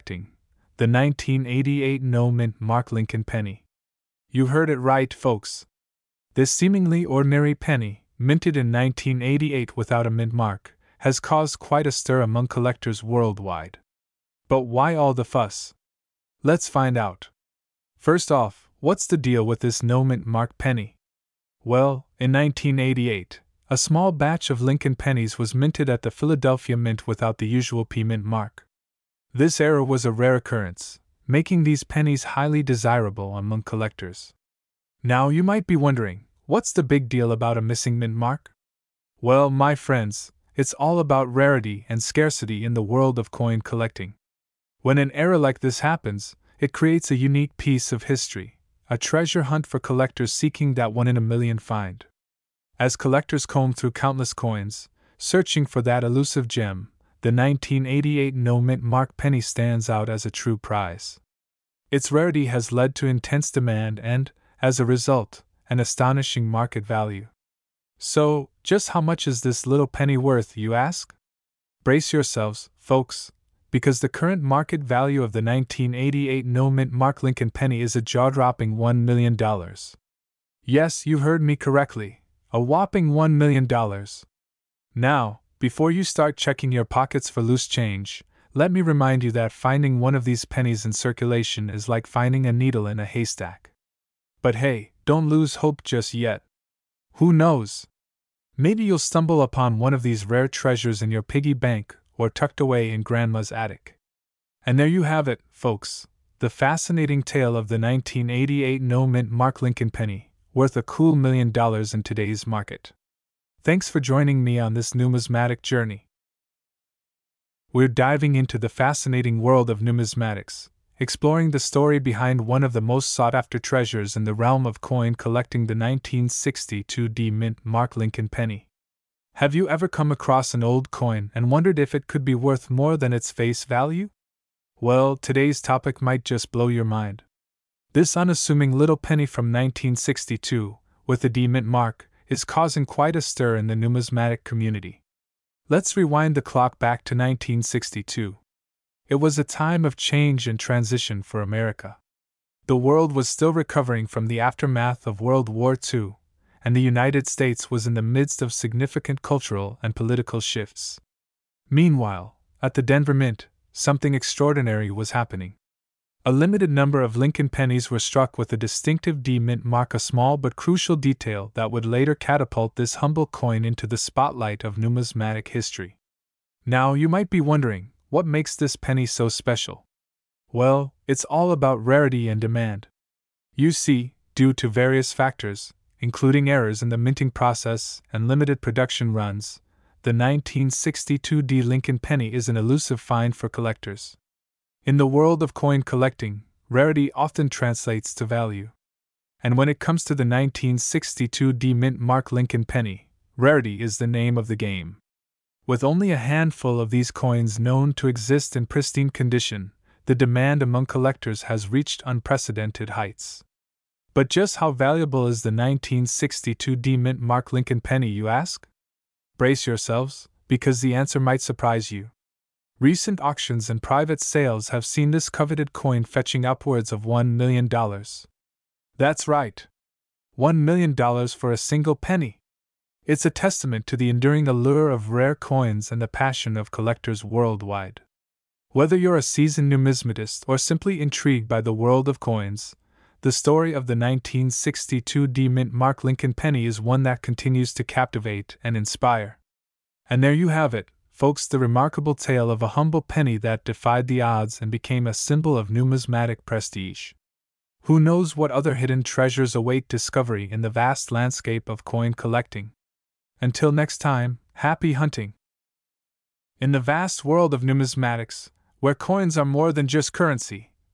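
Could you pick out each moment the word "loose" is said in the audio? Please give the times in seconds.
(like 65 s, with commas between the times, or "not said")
87 s.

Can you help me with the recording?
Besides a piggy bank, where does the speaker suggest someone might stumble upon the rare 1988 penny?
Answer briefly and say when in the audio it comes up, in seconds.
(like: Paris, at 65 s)
Grandma's attic, at 103 s.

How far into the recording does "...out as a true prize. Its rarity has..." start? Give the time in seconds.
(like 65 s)
59 s.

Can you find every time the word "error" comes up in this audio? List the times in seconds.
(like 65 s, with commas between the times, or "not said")
29 s, 45 s, 186 s.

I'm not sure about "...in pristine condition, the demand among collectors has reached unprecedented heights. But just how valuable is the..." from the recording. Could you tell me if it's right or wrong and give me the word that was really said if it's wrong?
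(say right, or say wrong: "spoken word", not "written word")
right.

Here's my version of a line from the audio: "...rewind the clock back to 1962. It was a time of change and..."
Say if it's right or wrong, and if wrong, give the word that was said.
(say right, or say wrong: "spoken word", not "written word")
right.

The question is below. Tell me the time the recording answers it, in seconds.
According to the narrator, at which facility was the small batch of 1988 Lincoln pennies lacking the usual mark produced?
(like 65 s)
26 s.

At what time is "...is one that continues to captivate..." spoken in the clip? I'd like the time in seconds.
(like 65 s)
246 s.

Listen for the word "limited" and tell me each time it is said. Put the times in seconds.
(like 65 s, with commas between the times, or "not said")
166 s, 188 s.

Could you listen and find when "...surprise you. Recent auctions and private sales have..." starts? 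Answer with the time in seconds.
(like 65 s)
221 s.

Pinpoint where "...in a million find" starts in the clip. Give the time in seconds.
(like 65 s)
51 s.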